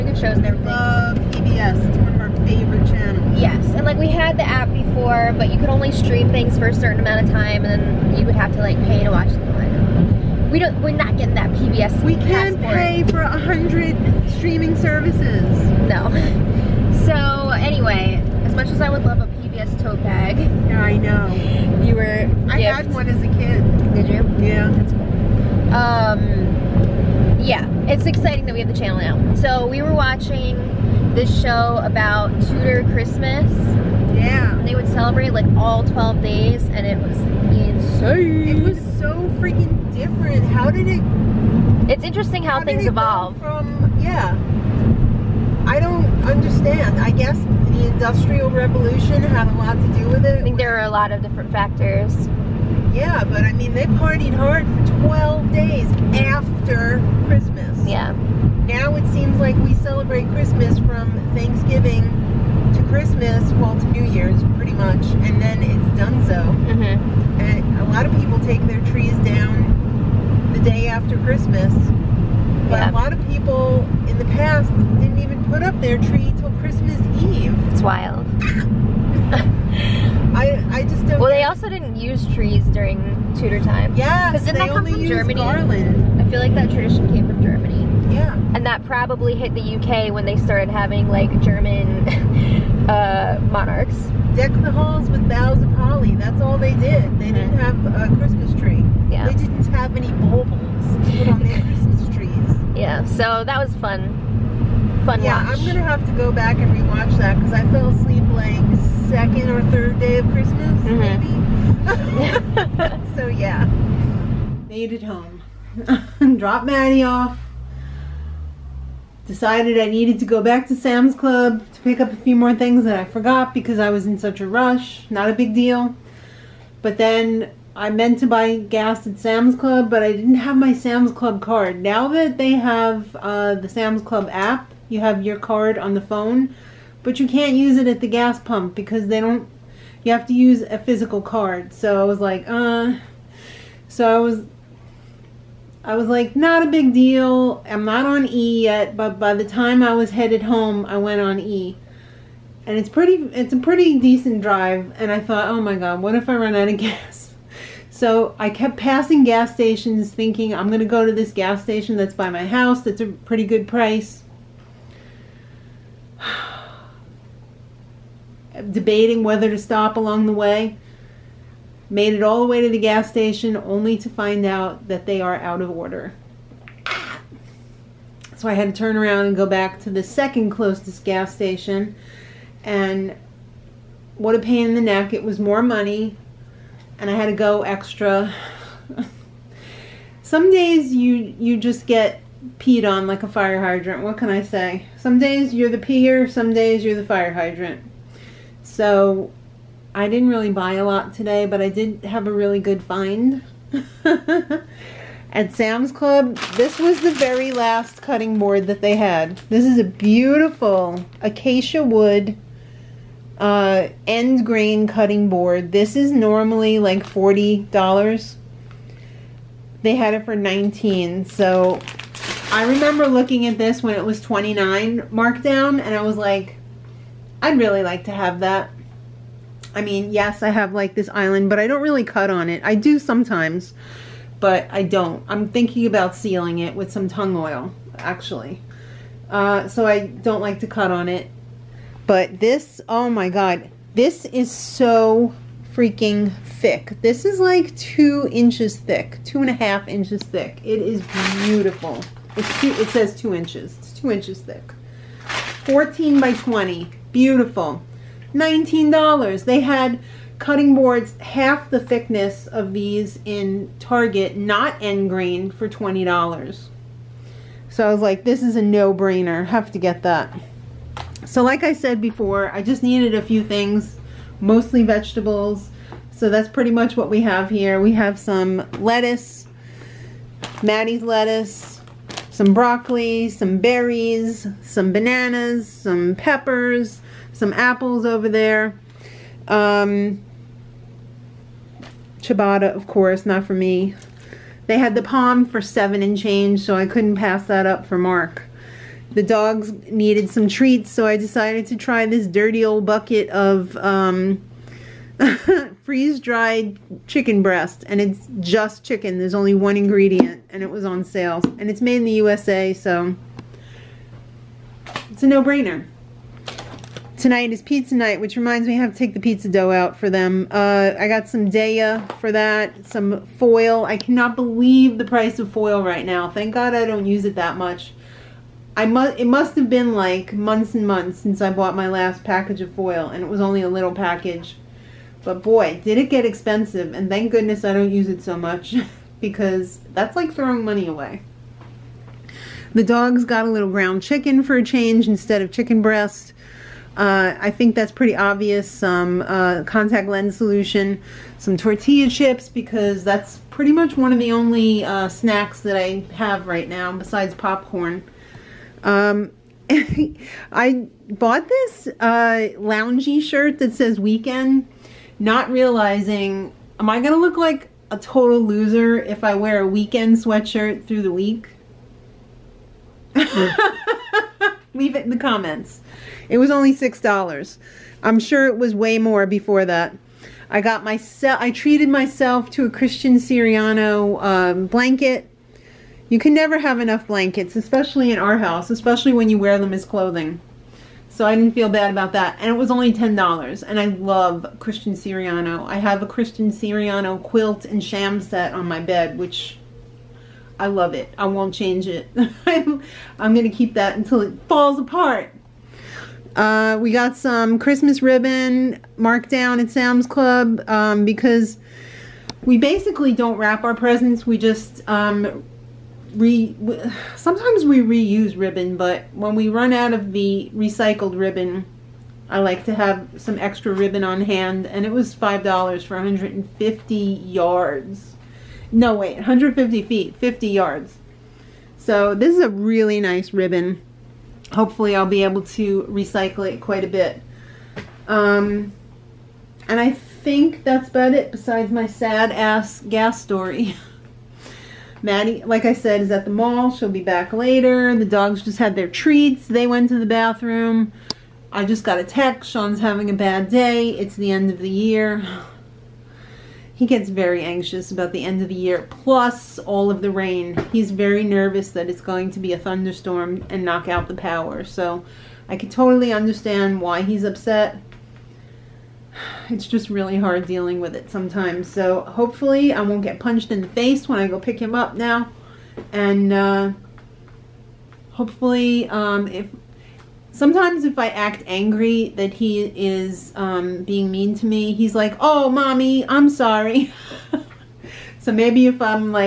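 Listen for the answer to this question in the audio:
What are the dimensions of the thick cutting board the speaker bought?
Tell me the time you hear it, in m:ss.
4:15.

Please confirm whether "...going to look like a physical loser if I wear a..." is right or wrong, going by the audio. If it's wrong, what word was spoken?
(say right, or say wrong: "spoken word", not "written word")
wrong: "total", not "physical".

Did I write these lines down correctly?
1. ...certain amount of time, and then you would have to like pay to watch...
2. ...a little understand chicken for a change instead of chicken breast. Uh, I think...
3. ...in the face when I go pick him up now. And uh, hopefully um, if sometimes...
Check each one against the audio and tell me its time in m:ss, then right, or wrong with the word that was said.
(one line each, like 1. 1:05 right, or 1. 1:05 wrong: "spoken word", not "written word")
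1. 0:06 right
2. 5:43 wrong: "ground", not "understand"
3. 7:53 right.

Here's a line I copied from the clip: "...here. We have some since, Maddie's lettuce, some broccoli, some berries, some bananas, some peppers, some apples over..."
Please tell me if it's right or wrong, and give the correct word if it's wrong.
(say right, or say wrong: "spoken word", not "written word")
wrong: "lettuce", not "since".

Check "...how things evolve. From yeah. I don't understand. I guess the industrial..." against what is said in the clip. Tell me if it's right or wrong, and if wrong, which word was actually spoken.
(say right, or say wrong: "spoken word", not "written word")
right.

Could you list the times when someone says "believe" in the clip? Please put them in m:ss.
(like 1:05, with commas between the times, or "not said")
5:24.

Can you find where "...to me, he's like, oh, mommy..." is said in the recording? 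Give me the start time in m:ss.
8:04.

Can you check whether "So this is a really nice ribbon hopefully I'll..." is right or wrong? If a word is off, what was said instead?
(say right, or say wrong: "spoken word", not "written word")
right.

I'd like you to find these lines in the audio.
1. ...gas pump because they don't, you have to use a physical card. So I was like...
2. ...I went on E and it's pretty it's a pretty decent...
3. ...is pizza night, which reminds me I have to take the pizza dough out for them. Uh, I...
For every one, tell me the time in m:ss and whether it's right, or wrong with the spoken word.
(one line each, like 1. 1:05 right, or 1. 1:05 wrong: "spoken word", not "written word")
1. 2:18 right
2. 2:30 right
3. 5:17 right.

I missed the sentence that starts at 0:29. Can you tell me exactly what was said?
So we were watching this show about Tudor Christmas.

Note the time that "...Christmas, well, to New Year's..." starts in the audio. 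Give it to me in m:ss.
1:02.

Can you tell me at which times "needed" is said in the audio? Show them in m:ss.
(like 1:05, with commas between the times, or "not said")
1:59, 4:32, 4:59.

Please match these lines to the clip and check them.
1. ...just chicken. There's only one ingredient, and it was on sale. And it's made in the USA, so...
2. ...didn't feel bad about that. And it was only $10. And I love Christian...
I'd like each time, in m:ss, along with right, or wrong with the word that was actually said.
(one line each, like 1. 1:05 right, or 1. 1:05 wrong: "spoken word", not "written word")
1. 5:08 right
2. 6:31 right.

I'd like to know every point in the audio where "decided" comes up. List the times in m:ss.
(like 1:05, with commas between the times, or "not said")
1:59, 5:01.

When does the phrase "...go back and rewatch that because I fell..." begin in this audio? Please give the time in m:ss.
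1:46.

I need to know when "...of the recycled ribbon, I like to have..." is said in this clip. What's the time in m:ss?
6:59.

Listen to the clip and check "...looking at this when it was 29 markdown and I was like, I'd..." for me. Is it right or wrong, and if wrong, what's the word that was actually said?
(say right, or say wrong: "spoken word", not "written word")
right.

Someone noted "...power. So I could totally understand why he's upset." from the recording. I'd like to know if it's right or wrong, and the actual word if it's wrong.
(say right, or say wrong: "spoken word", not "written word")
right.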